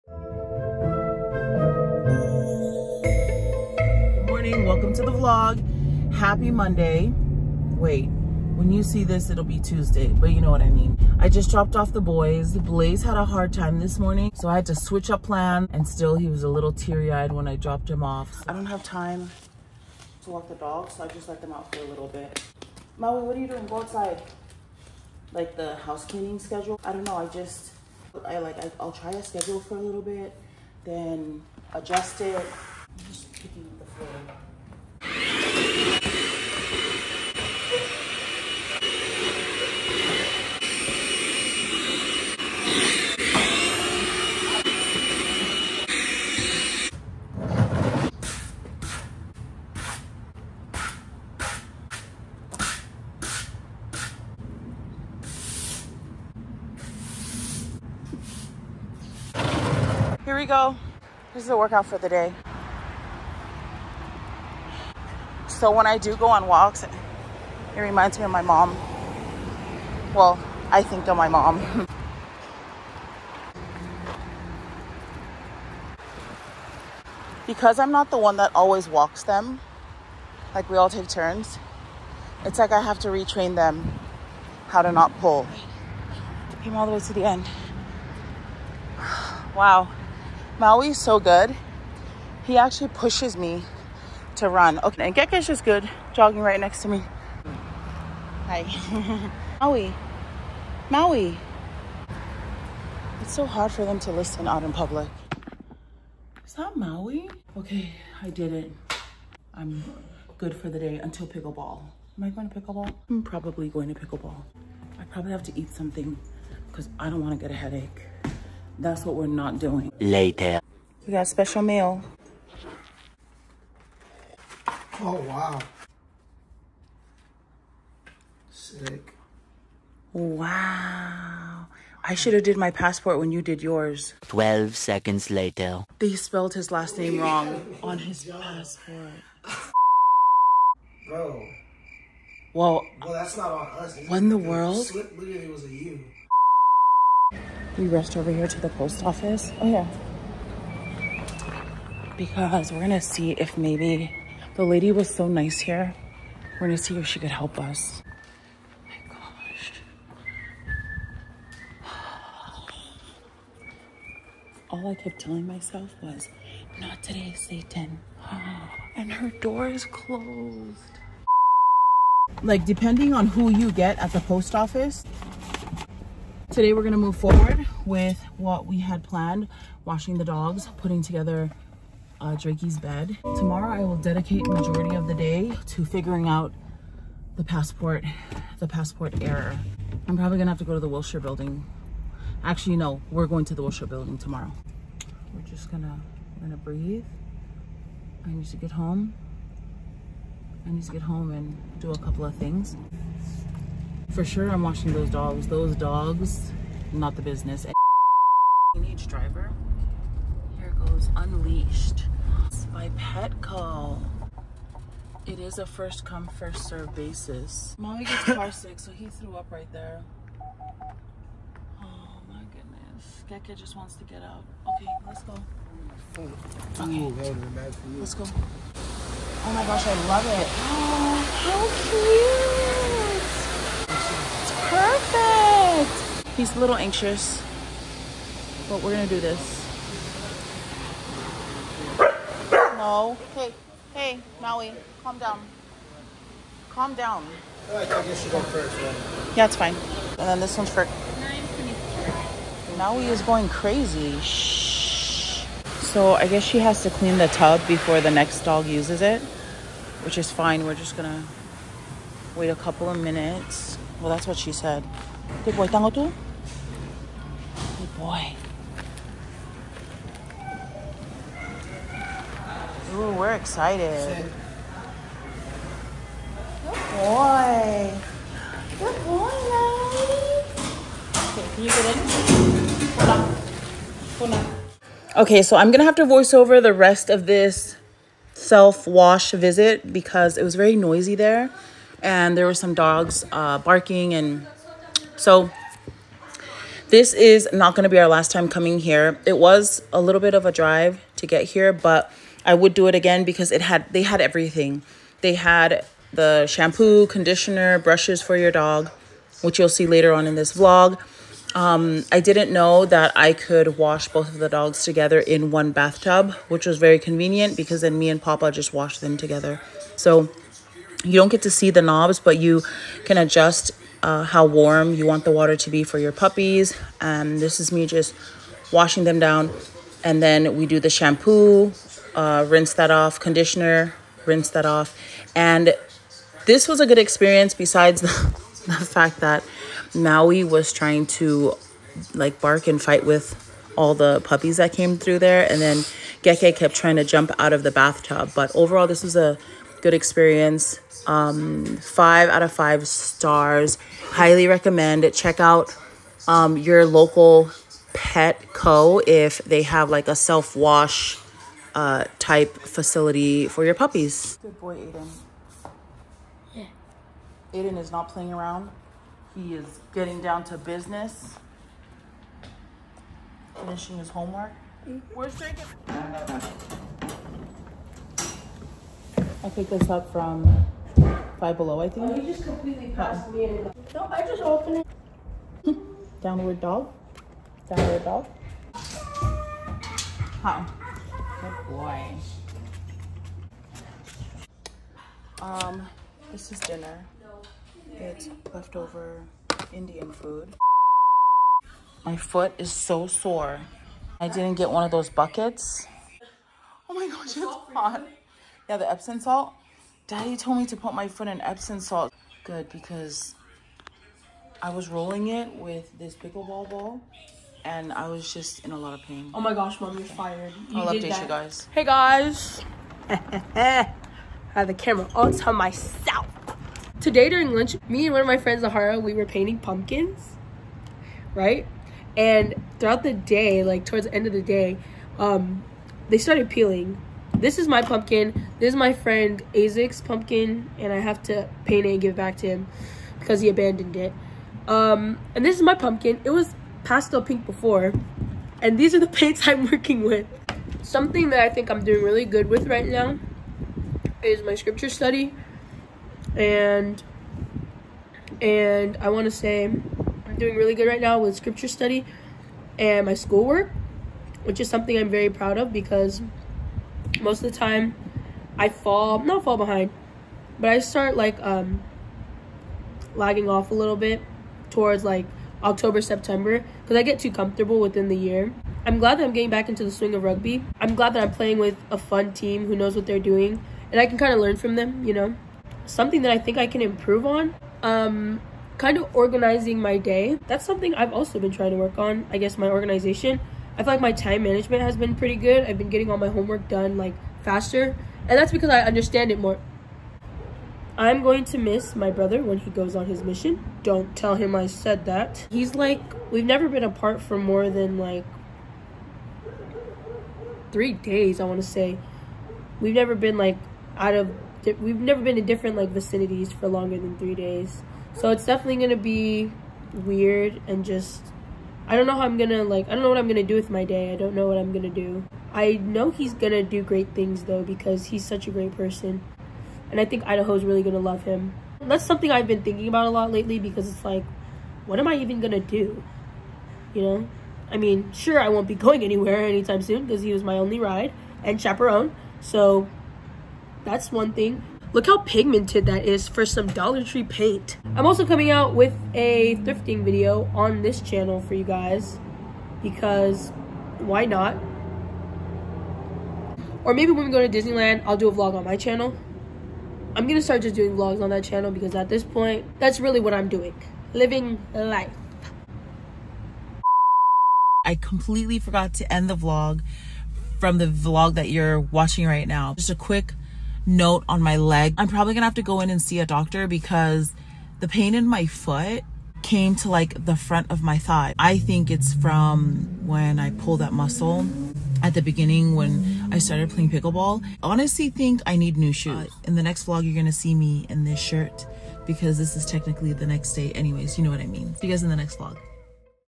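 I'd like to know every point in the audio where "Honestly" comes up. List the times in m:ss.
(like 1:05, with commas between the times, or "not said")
9:47.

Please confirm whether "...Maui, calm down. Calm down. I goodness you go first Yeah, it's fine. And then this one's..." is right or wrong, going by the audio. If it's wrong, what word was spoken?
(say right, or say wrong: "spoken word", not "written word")
wrong: "guess", not "goodness".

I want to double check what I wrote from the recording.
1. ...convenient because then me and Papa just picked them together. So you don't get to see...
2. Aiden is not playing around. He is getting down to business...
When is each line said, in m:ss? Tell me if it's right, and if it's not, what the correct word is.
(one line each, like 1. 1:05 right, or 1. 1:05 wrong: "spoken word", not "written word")
1. 5:16 wrong: "washed", not "picked"
2. 6:07 right.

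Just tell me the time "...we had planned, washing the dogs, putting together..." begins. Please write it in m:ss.
2:58.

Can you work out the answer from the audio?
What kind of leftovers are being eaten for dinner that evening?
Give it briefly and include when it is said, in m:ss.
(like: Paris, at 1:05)
Indian food, at 6:38.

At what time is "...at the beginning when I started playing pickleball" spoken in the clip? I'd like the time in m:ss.
9:45.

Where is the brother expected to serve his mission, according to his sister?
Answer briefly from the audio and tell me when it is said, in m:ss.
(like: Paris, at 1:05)
Idaho, at 8:50.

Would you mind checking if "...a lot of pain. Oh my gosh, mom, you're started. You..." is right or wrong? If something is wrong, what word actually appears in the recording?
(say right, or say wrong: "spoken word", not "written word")
wrong: "fired", not "started".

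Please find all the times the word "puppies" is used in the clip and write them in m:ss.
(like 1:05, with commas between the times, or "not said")
5:26, 5:44, 6:03.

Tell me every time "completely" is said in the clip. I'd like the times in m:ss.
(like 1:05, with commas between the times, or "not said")
6:22, 9:27.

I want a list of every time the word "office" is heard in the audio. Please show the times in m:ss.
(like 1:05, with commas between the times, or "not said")
2:29, 2:54.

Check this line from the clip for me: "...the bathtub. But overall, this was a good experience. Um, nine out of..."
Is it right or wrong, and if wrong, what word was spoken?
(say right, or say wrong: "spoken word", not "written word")
wrong: "five", not "nine".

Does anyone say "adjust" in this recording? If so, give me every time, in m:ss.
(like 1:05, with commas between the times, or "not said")
0:31, 5:23.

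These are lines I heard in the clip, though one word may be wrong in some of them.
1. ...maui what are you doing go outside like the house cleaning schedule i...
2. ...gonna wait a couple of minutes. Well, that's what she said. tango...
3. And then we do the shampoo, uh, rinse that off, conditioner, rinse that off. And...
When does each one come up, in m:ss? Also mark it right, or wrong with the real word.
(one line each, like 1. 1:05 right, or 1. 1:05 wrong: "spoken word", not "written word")
1. 0:22 right
2. 4:20 right
3. 5:30 right.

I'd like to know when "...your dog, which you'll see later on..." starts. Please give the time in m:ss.
5:08.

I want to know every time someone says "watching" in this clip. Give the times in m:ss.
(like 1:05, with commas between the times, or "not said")
3:24, 9:31.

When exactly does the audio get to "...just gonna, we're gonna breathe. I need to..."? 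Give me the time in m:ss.
3:15.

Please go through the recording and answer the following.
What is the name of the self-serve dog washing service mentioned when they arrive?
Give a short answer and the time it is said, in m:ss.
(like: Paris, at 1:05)
Unleashed, at 3:31.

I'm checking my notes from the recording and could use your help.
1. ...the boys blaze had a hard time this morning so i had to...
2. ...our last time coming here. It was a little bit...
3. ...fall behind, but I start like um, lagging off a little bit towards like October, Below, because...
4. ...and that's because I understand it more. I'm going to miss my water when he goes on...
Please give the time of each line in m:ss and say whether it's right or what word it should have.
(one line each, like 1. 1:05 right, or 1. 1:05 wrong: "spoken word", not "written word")
1. 0:11 right
2. 4:57 right
3. 7:49 wrong: "September", not "Below"
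4. 8:18 wrong: "brother", not "water".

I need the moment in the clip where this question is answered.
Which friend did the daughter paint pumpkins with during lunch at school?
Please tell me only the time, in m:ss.
7:08.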